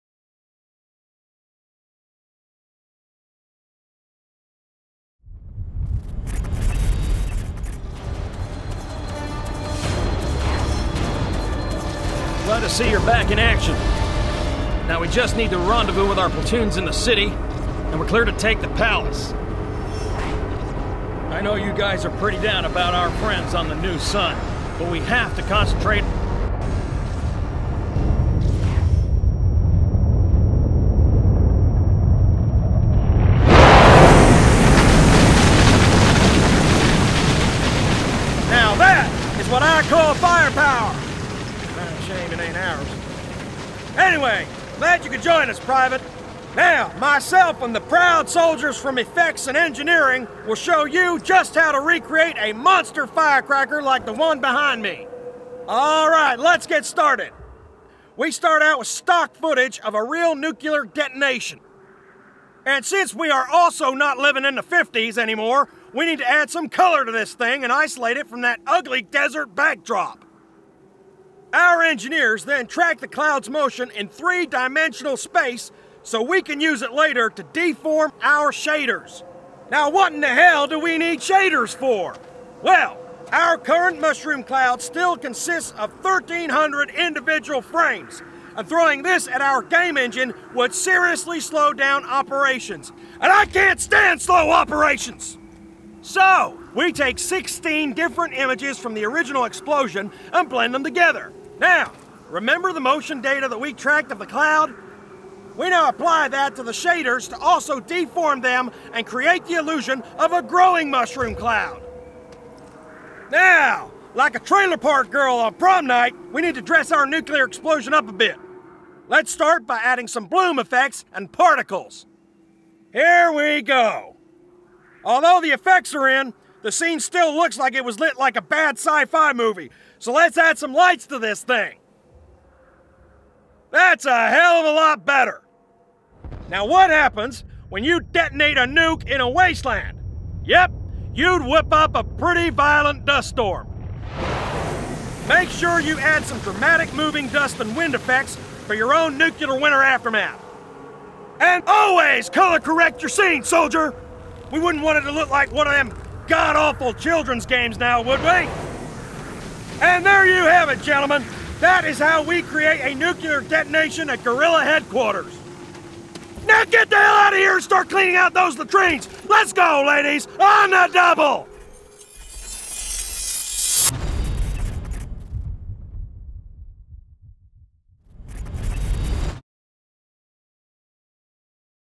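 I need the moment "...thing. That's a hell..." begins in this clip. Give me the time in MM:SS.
02:11.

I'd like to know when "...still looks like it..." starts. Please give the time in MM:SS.
02:06.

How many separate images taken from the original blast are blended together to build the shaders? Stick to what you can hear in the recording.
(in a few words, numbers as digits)
16.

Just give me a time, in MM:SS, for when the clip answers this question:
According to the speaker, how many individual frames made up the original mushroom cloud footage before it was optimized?
01:26.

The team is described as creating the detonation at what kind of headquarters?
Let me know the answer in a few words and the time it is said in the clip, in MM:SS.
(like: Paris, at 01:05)
Guerrilla headquarters, at 02:44.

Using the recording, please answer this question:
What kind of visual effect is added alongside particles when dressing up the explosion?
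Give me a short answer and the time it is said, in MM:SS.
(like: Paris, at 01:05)
Bloom effects, at 02:00.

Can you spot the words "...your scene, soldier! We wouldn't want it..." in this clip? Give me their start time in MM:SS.
02:33.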